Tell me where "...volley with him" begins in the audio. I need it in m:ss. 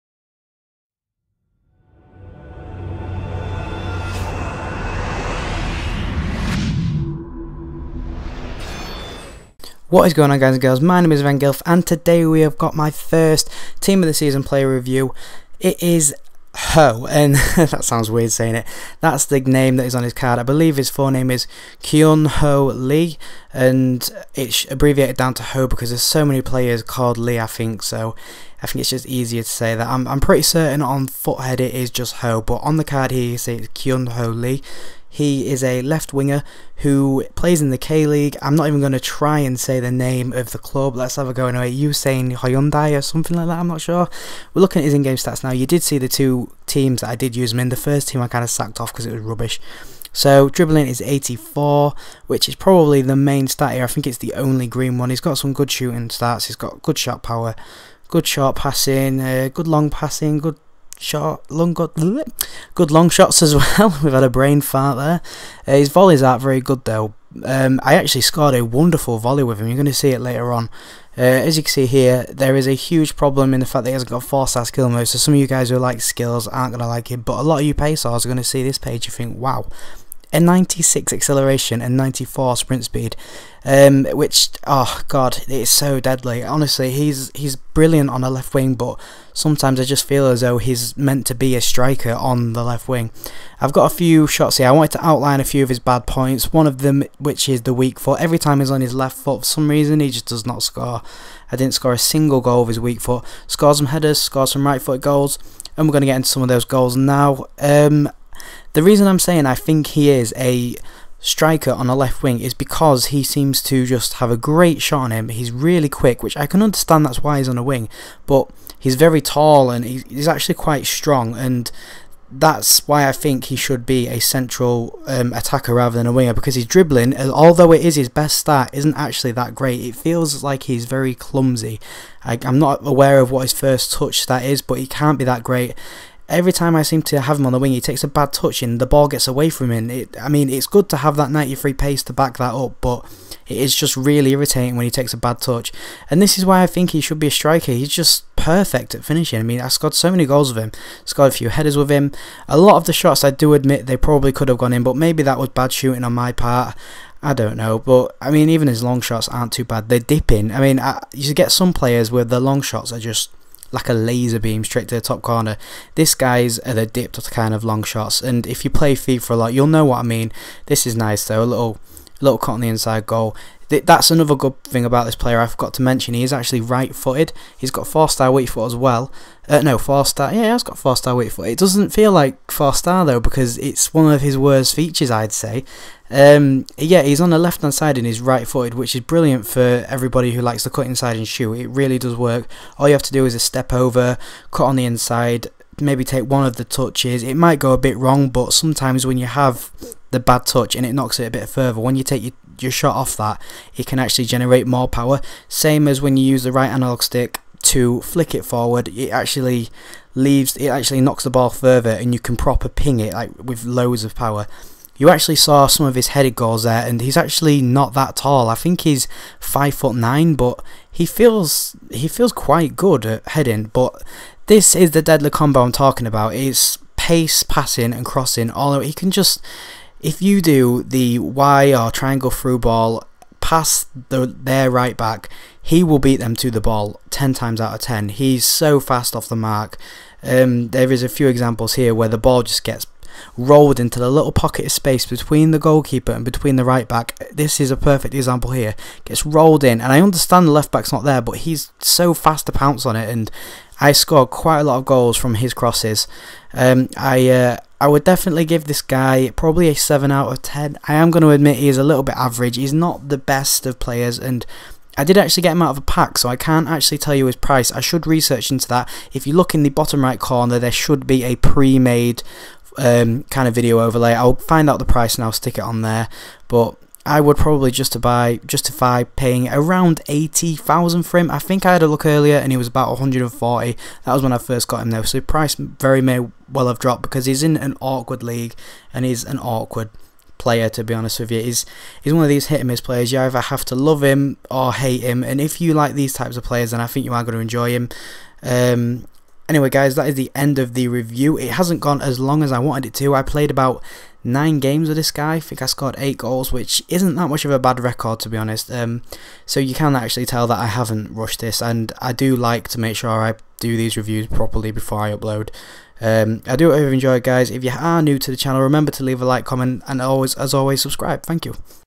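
1:09.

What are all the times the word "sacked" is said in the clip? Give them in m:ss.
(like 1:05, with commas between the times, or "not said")
0:48.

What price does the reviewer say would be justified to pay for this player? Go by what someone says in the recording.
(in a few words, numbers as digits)
80,000.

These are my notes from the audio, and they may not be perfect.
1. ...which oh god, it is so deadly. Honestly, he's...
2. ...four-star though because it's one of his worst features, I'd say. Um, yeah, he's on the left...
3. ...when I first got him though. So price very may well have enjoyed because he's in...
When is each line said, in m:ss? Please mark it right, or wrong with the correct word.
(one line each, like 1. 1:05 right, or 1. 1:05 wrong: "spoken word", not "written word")
1. 1:24 right
2. 3:02 right
3. 4:44 wrong: "dropped", not "enjoyed".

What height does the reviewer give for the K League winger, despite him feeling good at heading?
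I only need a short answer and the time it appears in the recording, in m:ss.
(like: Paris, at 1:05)
5 foot 9, at 3:39.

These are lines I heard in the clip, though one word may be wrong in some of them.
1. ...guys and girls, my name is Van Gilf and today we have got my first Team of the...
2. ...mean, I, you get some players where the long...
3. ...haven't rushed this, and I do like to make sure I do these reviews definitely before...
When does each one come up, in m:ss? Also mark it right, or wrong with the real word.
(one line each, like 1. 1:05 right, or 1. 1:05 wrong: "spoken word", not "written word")
1. 0:10 right
2. 2:40 right
3. 5:10 wrong: "properly", not "definitely".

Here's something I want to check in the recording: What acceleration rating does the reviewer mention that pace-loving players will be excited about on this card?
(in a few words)
96.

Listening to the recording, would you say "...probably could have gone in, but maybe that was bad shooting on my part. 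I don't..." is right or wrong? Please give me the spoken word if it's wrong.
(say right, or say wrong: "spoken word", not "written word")
right.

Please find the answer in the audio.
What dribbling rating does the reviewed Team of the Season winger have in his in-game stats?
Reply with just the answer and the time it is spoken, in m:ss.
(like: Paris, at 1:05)
84, at 0:51.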